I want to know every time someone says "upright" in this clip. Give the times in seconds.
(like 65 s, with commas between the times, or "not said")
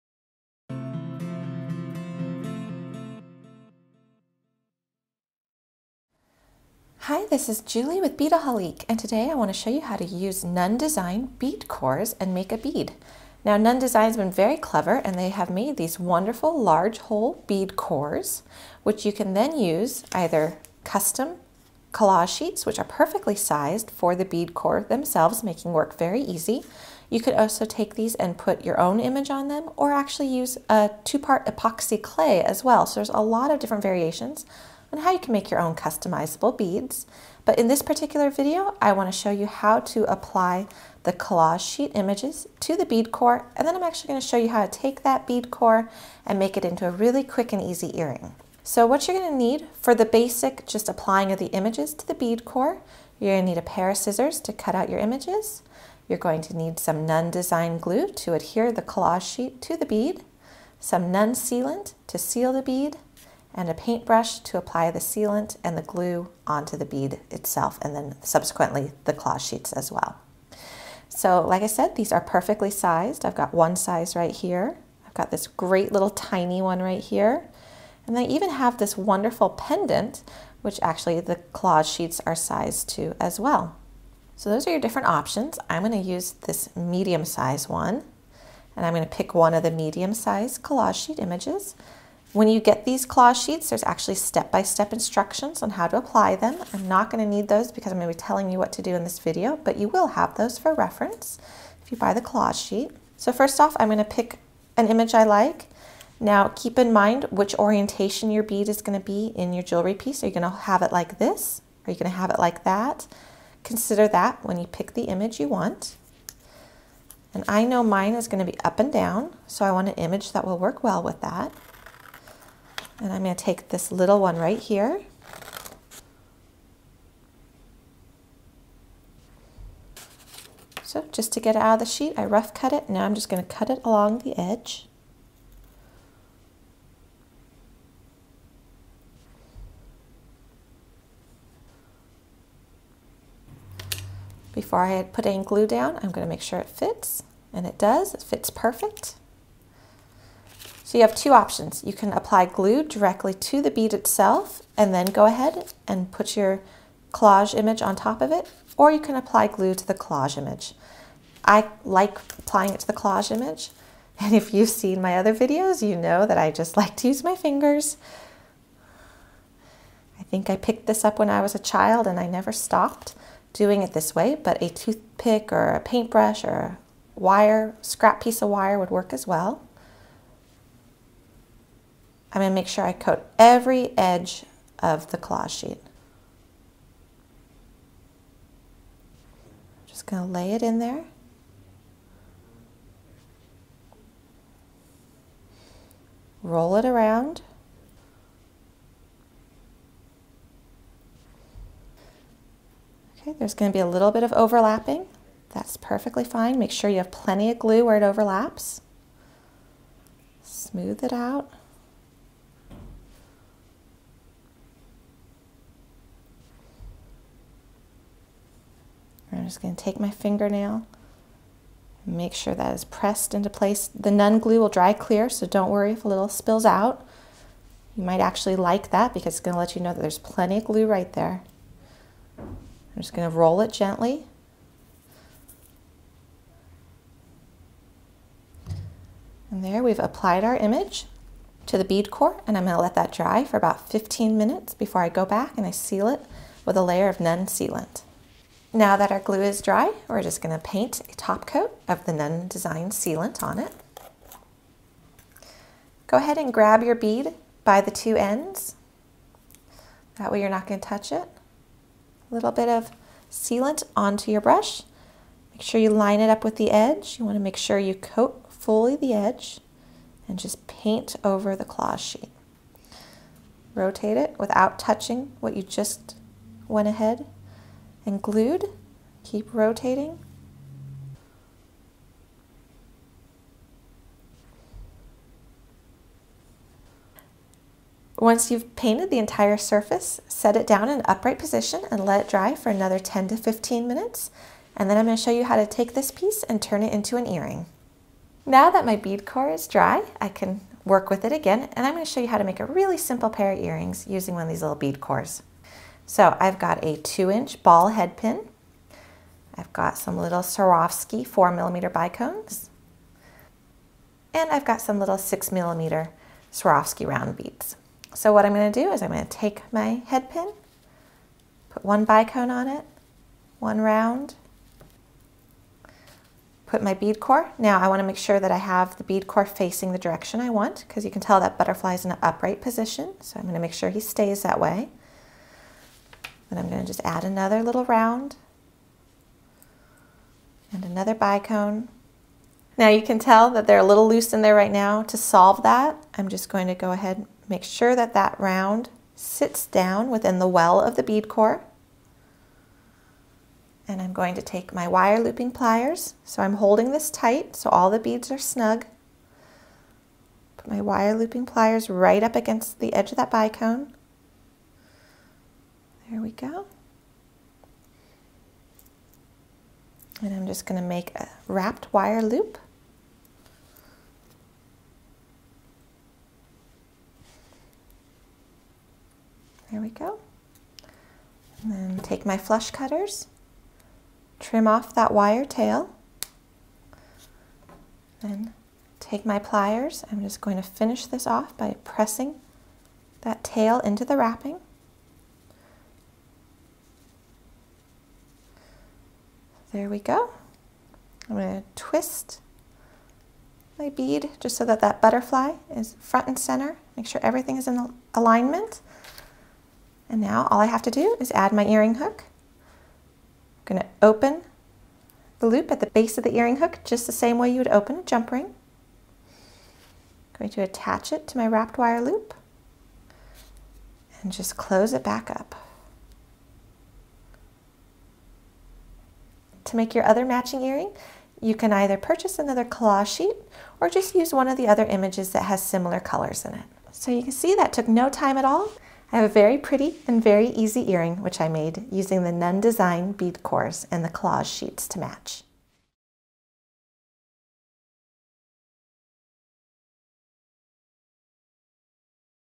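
291 s, 332 s.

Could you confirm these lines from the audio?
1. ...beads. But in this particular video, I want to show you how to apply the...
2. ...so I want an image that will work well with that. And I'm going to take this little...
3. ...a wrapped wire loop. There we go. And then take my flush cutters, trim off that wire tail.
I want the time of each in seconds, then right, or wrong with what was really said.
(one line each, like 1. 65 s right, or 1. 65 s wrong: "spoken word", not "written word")
1. 36 s right
2. 119 s right
3. 371 s right.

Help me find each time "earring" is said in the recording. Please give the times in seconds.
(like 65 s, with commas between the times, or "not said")
47 s, 297 s, 303 s, 411 s, 416 s, 430 s, 440 s.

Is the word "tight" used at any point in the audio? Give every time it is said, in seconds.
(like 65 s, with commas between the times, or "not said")
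357 s.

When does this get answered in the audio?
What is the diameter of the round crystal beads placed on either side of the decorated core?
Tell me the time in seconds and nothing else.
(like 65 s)
315 s.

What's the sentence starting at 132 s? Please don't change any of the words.
Now I'm just going to cut it along the edge.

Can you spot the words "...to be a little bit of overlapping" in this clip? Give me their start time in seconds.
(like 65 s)
203 s.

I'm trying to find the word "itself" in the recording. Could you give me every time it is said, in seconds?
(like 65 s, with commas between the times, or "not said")
67 s, 153 s.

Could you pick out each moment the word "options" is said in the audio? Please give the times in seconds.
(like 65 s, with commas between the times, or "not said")
85 s, 151 s.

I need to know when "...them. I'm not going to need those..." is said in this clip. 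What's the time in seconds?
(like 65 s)
96 s.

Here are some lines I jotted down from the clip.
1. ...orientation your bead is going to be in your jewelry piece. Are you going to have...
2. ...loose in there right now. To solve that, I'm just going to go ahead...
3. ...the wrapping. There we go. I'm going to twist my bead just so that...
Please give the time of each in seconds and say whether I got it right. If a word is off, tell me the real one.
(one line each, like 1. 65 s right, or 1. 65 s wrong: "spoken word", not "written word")
1. 107 s right
2. 344 s right
3. 394 s right.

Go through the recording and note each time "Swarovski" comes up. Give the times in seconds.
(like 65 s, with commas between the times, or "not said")
310 s, 316 s.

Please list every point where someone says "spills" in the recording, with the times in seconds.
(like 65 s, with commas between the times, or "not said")
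226 s.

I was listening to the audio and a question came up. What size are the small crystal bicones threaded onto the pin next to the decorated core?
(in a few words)
4 millimeters.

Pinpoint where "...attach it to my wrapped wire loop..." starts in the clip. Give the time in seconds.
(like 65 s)
420 s.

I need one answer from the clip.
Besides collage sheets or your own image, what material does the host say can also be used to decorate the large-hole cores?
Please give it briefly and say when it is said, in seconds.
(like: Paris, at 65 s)
two-part epoxy clay, at 31 s.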